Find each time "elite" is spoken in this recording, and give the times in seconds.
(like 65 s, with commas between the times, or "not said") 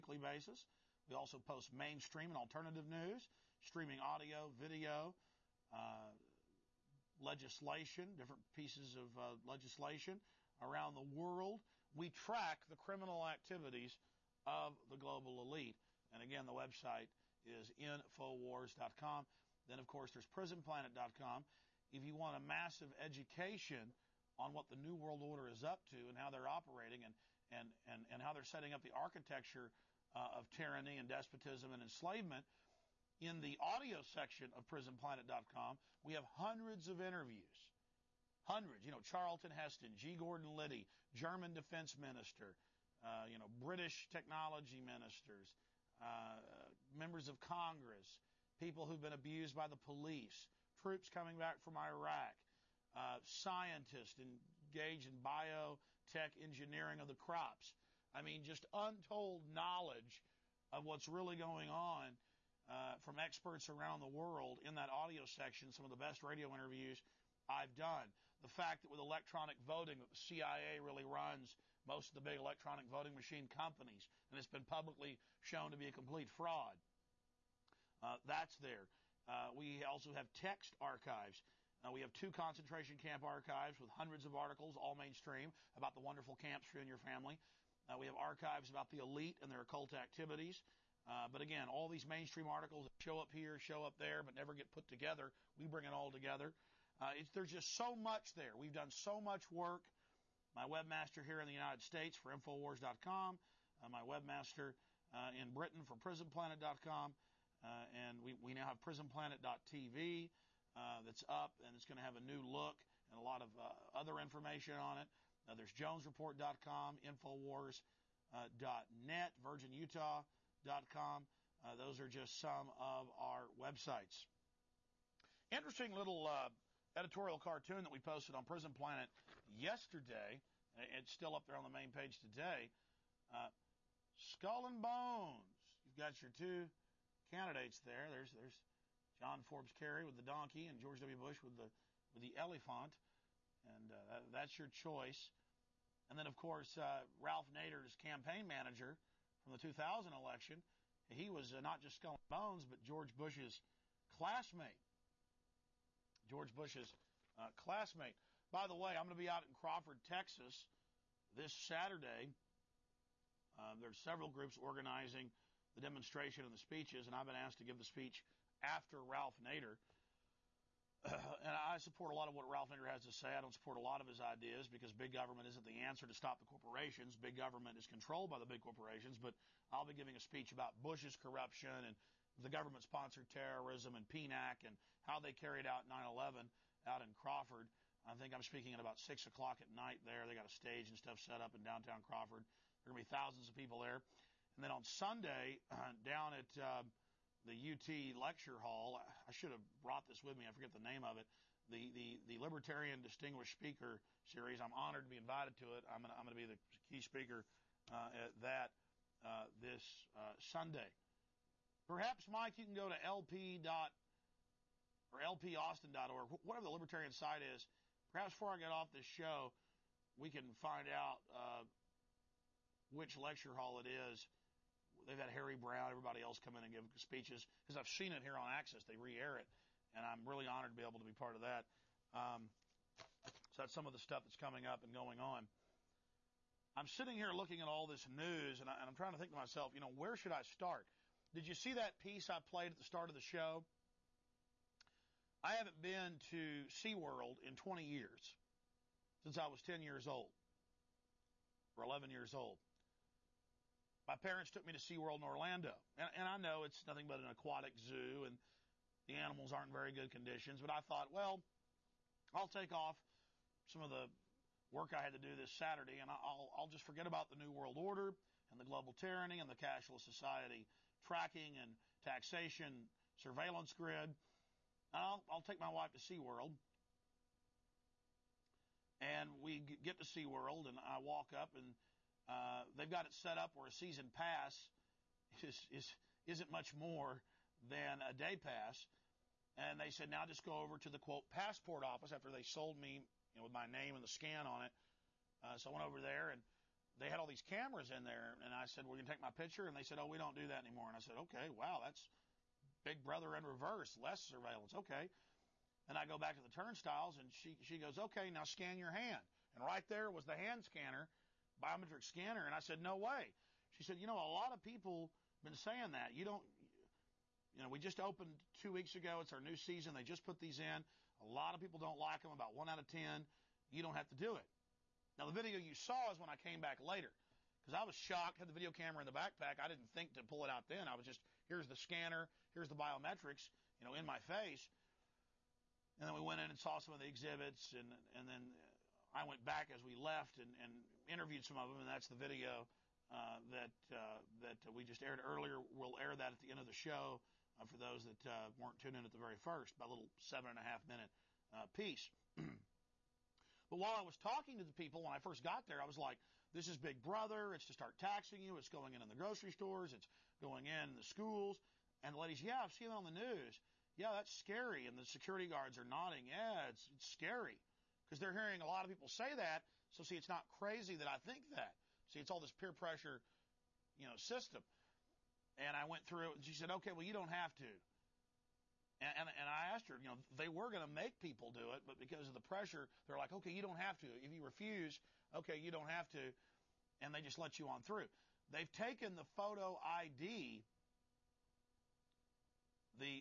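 15 s, 88 s.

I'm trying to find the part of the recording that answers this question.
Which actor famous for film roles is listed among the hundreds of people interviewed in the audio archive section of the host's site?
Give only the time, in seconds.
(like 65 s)
39 s.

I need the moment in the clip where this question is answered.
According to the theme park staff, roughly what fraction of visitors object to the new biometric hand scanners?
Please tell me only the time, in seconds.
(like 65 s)
322 s.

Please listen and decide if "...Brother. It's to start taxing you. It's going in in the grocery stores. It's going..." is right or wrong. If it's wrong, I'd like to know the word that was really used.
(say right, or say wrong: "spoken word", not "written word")
right.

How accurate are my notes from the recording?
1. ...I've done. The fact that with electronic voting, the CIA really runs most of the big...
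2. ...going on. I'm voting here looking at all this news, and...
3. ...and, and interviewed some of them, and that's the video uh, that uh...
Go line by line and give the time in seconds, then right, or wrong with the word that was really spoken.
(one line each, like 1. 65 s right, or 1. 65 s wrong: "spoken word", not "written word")
1. 67 s right
2. 234 s wrong: "sitting", not "voting"
3. 340 s right.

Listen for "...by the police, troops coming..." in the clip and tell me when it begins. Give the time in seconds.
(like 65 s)
49 s.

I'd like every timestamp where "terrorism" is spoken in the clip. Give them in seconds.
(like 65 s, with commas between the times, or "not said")
183 s.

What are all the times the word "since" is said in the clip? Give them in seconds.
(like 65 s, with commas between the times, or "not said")
249 s.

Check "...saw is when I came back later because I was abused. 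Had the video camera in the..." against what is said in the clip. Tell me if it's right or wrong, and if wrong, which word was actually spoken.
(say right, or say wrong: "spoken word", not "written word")
wrong: "shocked", not "abused".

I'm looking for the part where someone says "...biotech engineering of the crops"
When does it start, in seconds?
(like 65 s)
55 s.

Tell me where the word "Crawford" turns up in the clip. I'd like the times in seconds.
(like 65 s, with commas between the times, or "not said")
159 s, 187 s, 192 s.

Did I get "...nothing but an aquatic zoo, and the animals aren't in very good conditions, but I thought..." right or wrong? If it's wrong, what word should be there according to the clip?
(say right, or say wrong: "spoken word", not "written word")
right.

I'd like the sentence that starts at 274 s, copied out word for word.
I'll, I'll take my wife to SeaWorld.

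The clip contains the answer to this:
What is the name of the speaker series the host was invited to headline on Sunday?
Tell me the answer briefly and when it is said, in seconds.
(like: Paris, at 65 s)
Libertarian Distinguished Speaker Series, at 202 s.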